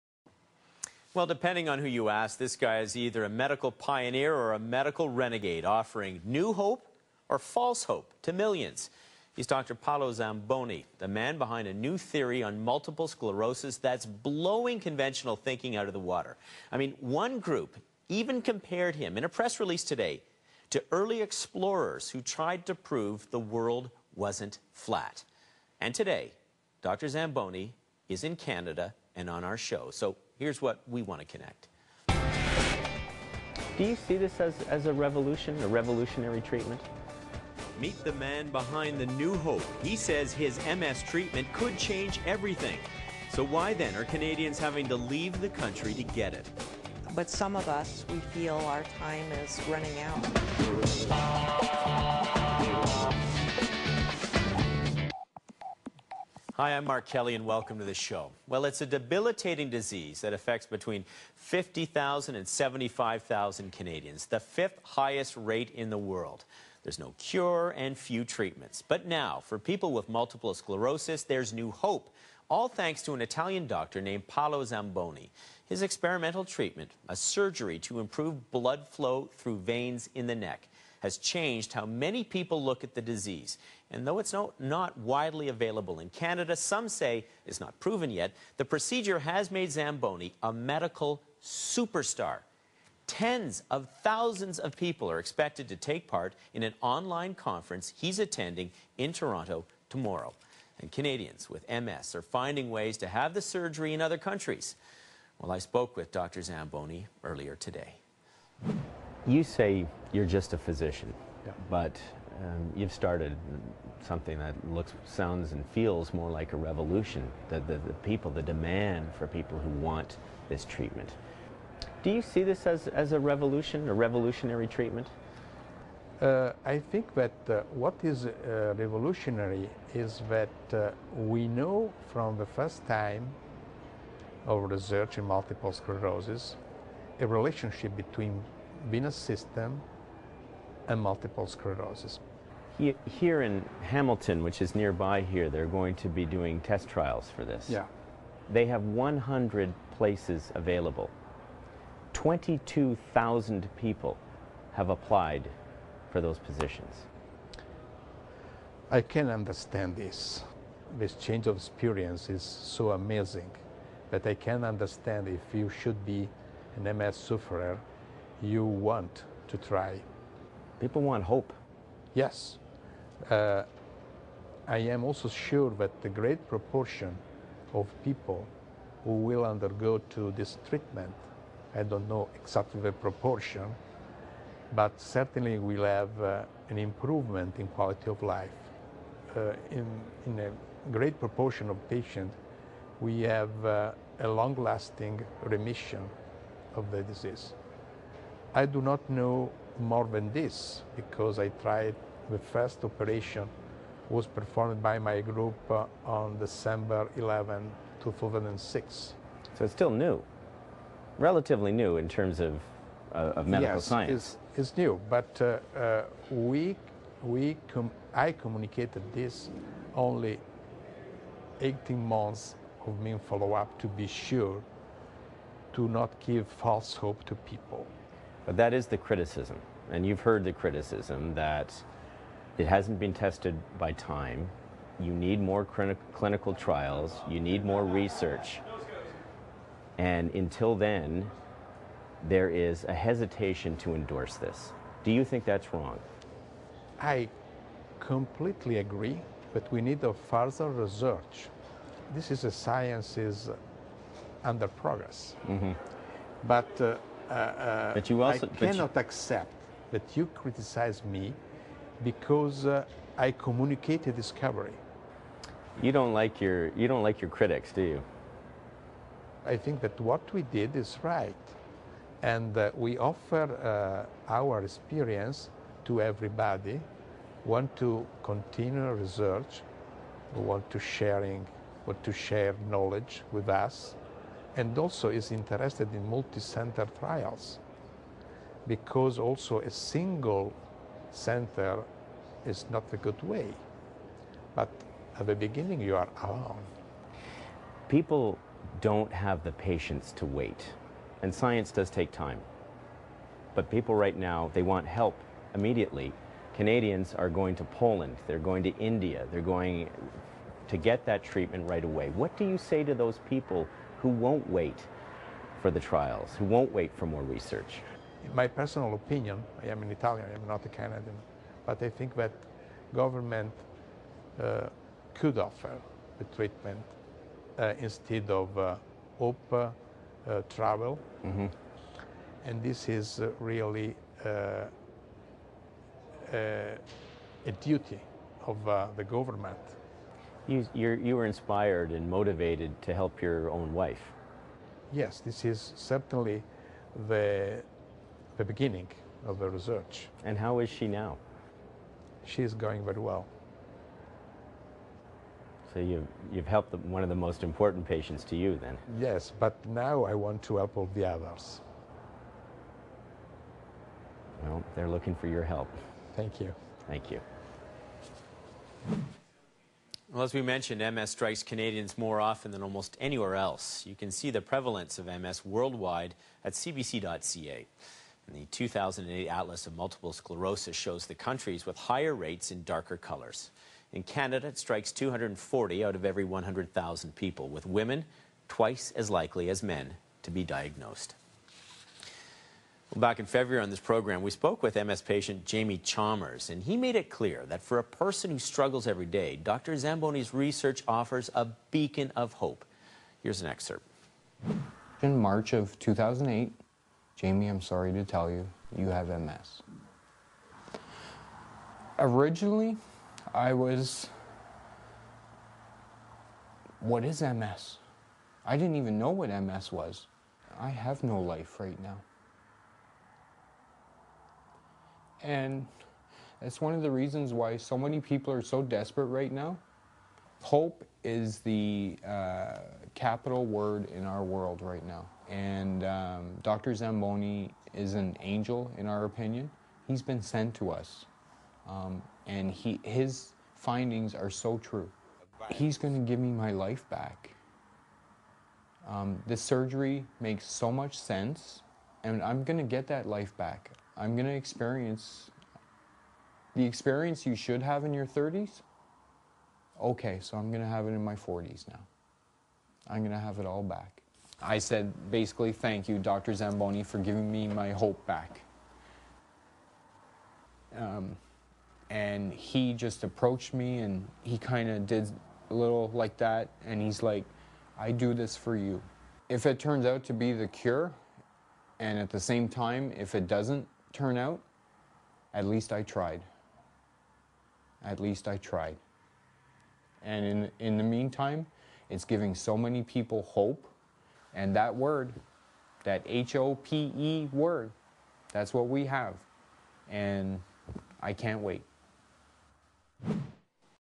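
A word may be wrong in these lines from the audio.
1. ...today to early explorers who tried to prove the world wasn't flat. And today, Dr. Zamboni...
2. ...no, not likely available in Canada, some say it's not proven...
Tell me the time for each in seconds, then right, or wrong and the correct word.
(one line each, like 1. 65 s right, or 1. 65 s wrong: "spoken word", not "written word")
1. 19 s right
2. 84 s wrong: "widely", not "likely".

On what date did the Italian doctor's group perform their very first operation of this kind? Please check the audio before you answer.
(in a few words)
December 11, 2006.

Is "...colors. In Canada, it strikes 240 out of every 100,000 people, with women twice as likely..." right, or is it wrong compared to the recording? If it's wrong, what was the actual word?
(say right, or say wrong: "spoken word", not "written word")
right.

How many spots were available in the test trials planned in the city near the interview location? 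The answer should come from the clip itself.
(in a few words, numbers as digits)
100.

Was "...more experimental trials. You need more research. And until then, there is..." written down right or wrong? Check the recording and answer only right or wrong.
wrong.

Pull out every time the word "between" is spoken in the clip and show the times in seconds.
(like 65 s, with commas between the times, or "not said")
60 s, 137 s.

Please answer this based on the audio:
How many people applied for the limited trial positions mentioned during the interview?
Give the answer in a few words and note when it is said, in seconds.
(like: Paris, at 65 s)
22,000, at 152 s.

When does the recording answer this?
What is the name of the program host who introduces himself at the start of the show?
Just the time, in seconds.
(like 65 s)
56 s.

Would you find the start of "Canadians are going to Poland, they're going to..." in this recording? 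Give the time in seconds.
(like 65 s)
306 s.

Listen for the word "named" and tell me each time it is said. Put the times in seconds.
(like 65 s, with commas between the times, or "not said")
73 s.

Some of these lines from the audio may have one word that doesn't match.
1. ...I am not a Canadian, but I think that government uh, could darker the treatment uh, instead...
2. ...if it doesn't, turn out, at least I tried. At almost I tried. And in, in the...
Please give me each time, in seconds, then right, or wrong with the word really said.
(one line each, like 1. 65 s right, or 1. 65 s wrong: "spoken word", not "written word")
1. 320 s wrong: "offer", not "darker"
2. 482 s wrong: "least", not "almost".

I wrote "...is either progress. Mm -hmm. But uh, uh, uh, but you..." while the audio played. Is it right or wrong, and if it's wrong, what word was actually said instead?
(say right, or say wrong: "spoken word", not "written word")
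wrong: "under", not "either".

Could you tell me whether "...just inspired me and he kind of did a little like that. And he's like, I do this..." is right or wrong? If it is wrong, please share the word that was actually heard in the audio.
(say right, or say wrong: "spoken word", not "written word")
wrong: "approached", not "inspired".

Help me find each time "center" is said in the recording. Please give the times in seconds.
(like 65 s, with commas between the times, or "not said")
286 s, 291 s.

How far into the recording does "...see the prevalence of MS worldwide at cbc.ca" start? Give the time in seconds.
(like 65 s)
374 s.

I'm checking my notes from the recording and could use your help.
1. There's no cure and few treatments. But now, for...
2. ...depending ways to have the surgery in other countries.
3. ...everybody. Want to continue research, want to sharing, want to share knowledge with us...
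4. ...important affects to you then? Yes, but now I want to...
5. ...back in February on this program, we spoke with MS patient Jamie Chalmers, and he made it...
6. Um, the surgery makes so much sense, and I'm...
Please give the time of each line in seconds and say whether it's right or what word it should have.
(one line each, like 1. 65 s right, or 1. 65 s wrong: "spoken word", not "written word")
1. 66 s right
2. 102 s wrong: "finding", not "depending"
3. 276 s right
4. 357 s wrong: "patients", not "affects"
5. 392 s right
6. 448 s right.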